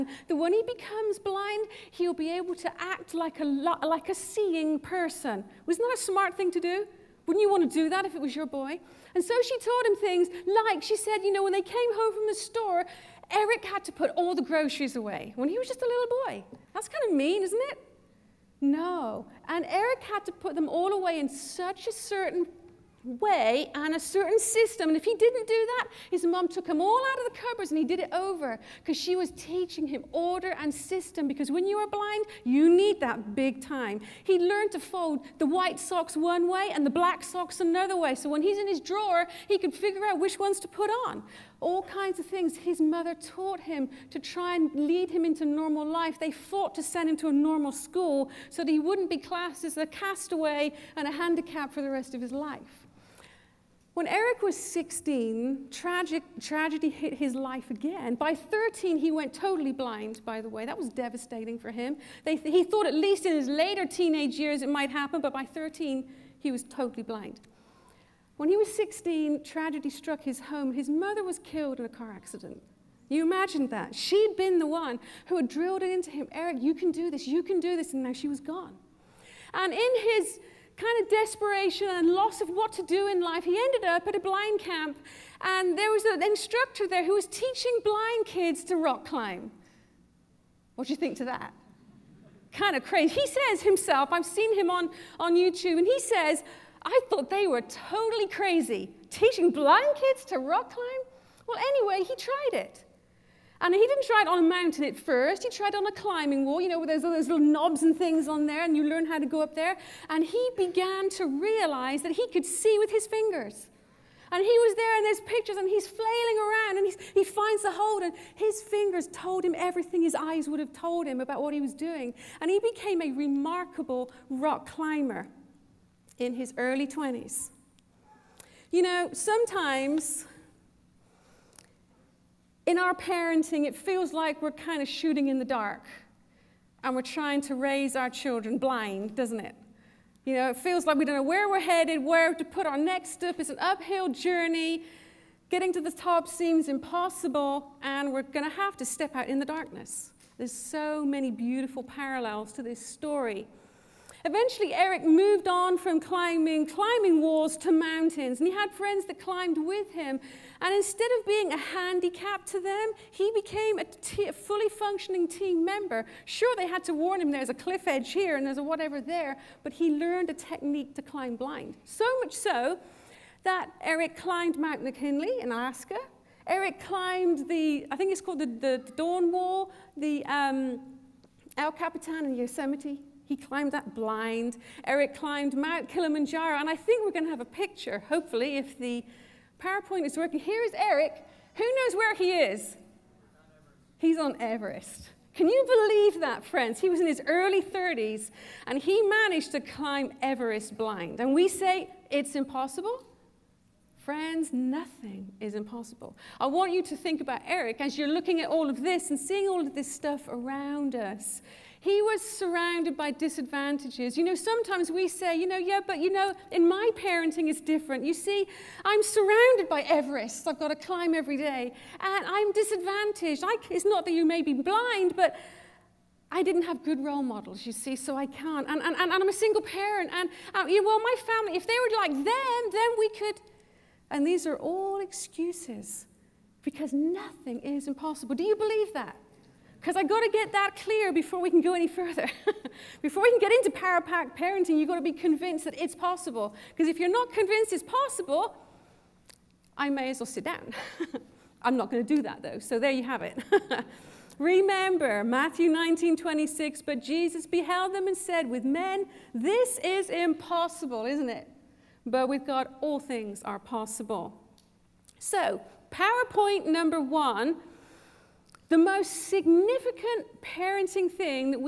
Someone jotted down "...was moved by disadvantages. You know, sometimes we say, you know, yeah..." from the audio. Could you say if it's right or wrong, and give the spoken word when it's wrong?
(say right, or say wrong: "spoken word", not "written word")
wrong: "surrounded", not "moved".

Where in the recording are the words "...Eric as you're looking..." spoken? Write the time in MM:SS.
03:27.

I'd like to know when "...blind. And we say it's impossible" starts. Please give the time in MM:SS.
03:20.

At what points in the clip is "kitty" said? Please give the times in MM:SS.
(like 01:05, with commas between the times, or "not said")
not said.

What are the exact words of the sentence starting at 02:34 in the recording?
Eventually, Eric moved on from climbing, climbing walls to mountains, and he had friends that climbed with him.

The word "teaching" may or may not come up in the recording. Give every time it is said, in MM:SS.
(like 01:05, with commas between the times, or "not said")
00:29, 01:27, 01:39.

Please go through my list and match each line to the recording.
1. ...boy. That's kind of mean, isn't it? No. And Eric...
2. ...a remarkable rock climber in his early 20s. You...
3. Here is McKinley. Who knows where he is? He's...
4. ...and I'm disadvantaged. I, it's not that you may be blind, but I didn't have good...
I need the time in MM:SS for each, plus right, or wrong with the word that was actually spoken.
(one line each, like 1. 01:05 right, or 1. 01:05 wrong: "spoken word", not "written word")
1. 00:16 right
2. 02:03 right
3. 03:10 wrong: "Eric", not "McKinley"
4. 03:42 right.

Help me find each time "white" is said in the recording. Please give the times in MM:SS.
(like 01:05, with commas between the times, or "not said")
00:35.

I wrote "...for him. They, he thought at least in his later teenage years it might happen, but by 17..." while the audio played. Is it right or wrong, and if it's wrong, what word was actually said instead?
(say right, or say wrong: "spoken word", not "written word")
wrong: "13", not "17".